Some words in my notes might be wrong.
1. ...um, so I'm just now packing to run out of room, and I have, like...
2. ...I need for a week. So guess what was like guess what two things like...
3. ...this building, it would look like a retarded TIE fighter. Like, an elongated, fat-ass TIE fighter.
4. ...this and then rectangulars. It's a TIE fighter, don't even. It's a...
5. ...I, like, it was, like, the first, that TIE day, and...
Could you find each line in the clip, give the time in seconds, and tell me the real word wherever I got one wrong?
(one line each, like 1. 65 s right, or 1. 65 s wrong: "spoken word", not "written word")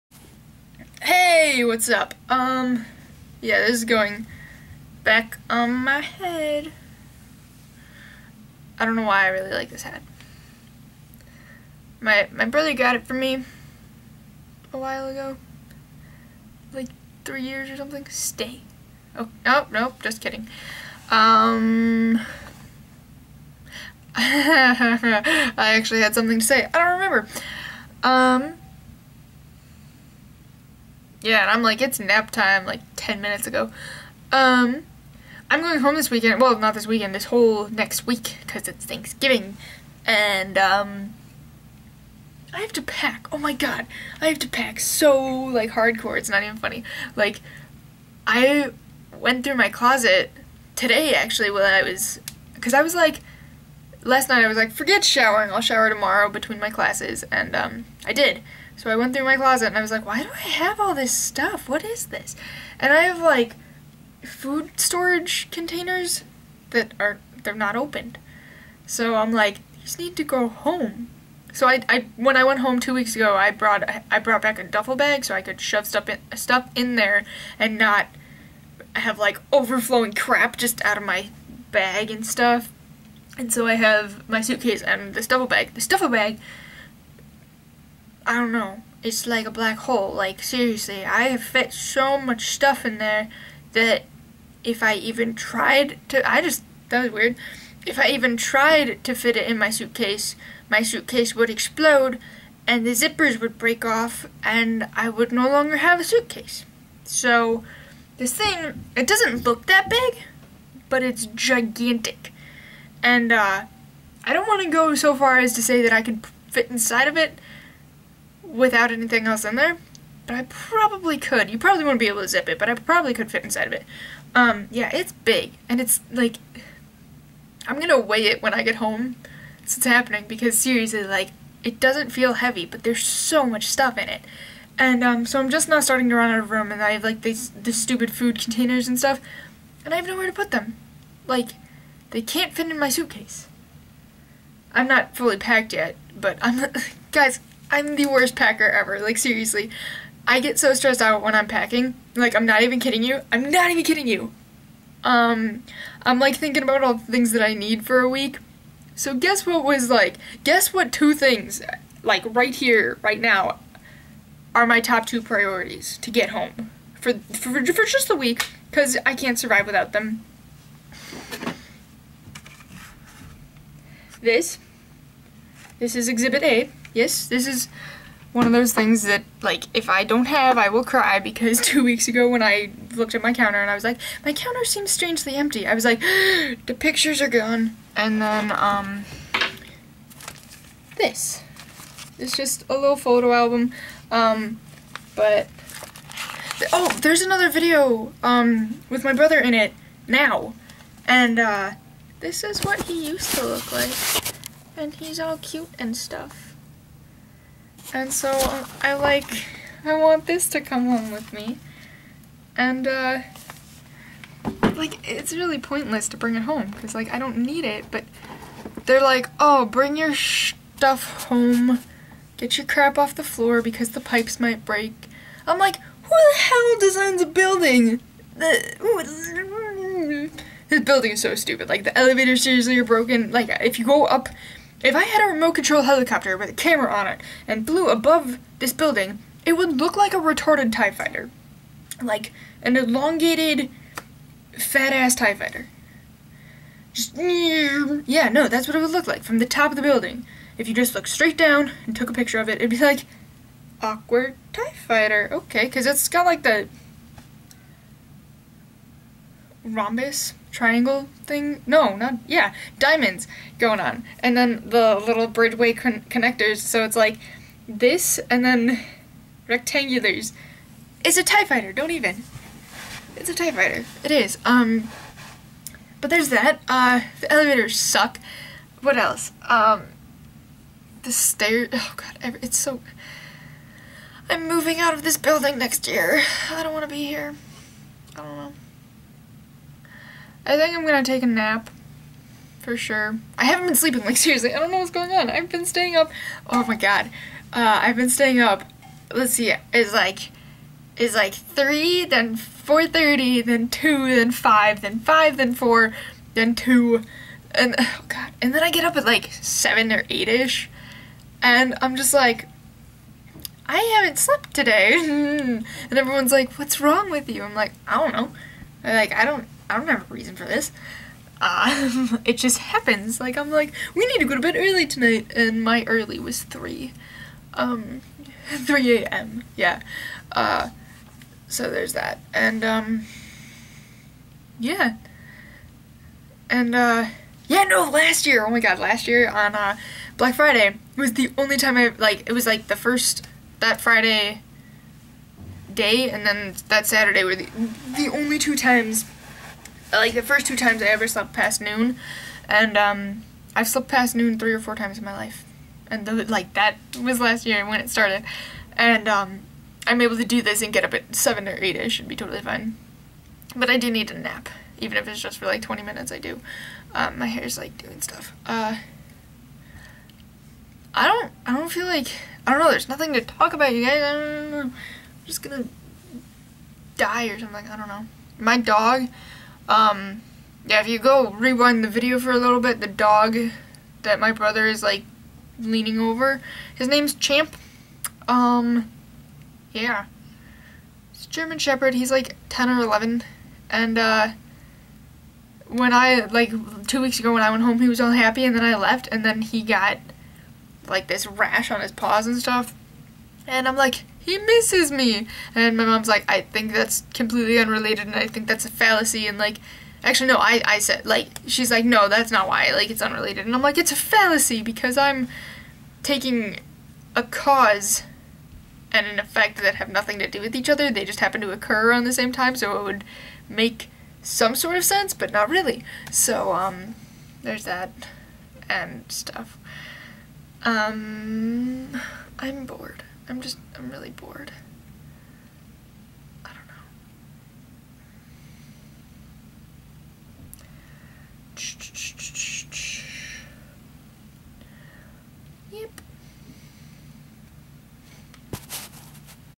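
1. 135 s wrong: "starting", not "packing"
2. 157 s right
3. 238 s right
4. 267 s right
5. 341 s wrong: "Friday", not "TIE".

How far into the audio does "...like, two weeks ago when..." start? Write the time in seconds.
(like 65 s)
396 s.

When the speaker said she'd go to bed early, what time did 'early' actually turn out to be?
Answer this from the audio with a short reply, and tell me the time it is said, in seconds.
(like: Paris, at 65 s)
3 a.m., at 328 s.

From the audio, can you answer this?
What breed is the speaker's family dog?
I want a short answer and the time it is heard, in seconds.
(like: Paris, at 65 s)
German Shepherd, at 391 s.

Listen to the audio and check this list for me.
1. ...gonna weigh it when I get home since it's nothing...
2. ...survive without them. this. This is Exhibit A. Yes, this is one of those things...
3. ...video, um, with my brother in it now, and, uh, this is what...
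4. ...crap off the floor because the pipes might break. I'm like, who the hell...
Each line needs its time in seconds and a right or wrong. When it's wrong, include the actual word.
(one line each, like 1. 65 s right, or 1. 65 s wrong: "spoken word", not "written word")
1. 127 s wrong: "happening", not "nothing"
2. 169 s right
3. 197 s right
4. 222 s right.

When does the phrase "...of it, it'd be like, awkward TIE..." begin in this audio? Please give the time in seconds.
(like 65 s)
252 s.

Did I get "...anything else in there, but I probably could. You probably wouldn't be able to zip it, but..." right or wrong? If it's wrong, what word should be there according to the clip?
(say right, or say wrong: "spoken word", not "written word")
right.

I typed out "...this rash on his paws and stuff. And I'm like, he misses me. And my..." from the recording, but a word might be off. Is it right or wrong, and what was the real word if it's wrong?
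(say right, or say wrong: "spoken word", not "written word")
right.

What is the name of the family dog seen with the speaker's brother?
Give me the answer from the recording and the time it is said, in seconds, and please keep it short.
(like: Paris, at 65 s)
Champ, at 387 s.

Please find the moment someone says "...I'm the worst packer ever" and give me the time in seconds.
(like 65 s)
147 s.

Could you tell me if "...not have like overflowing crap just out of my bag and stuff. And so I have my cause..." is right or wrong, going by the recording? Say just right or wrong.
wrong.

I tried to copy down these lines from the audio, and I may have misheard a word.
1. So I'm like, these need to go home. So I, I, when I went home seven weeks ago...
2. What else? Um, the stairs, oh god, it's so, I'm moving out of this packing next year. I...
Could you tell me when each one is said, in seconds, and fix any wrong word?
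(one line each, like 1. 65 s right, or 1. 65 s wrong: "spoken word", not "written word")
1. 68 s wrong: "two", not "seven"
2. 278 s wrong: "building", not "packing".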